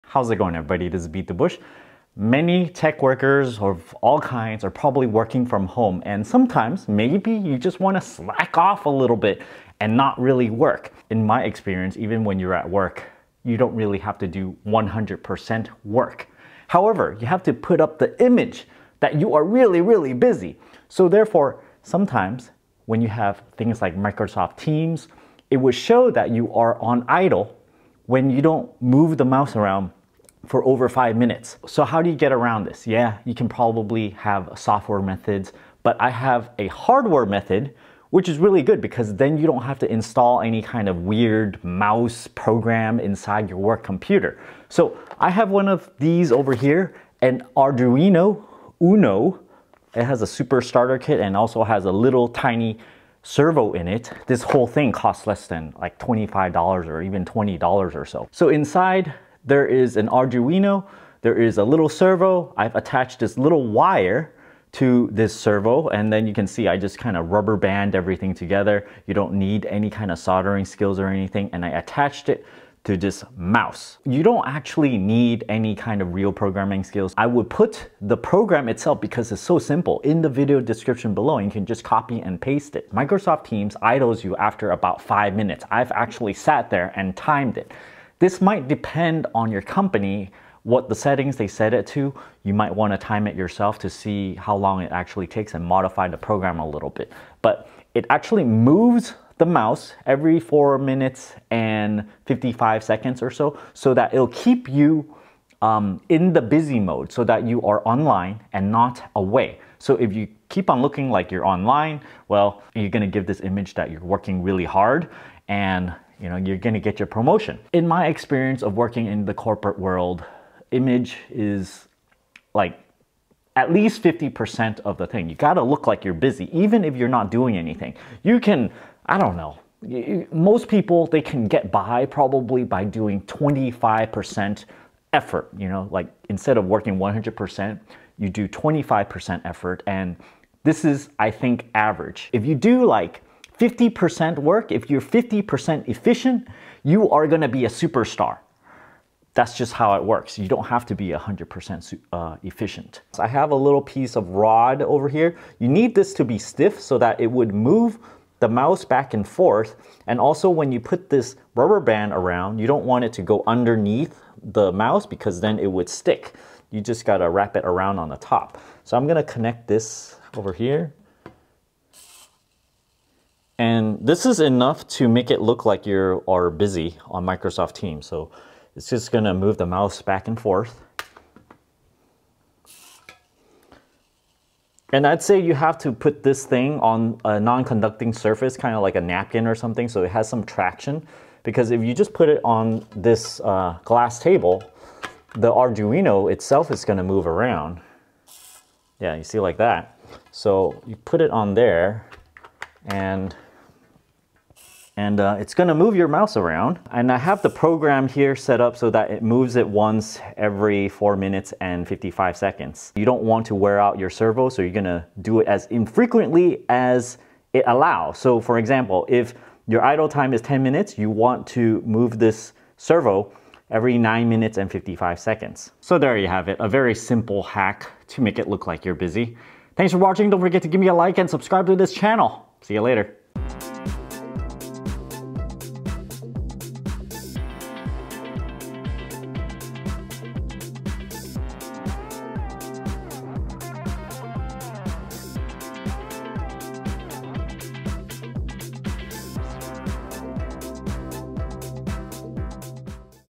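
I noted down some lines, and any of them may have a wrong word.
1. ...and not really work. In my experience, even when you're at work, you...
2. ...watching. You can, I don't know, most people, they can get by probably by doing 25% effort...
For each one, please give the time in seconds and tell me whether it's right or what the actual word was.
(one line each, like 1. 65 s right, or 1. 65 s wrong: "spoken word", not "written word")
1. 9 s right
2. 127 s wrong: "anything", not "watching".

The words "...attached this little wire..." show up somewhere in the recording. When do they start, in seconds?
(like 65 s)
62 s.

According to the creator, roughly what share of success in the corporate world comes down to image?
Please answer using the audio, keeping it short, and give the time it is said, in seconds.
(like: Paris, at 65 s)
50%, at 123 s.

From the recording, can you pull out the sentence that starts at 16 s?
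However, you have to put up the image that you are really, really busy.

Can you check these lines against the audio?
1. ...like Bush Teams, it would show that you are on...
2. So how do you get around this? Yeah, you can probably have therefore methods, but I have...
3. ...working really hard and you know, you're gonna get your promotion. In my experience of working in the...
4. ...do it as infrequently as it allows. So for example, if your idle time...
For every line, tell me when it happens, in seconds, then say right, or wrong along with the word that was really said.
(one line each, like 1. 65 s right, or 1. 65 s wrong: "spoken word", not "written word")
1. 23 s wrong: "Microsoft", not "Bush"
2. 31 s wrong: "software", not "therefore"
3. 114 s right
4. 215 s right.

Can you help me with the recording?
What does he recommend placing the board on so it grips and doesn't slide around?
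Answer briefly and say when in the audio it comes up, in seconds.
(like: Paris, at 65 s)
A napkin, at 188 s.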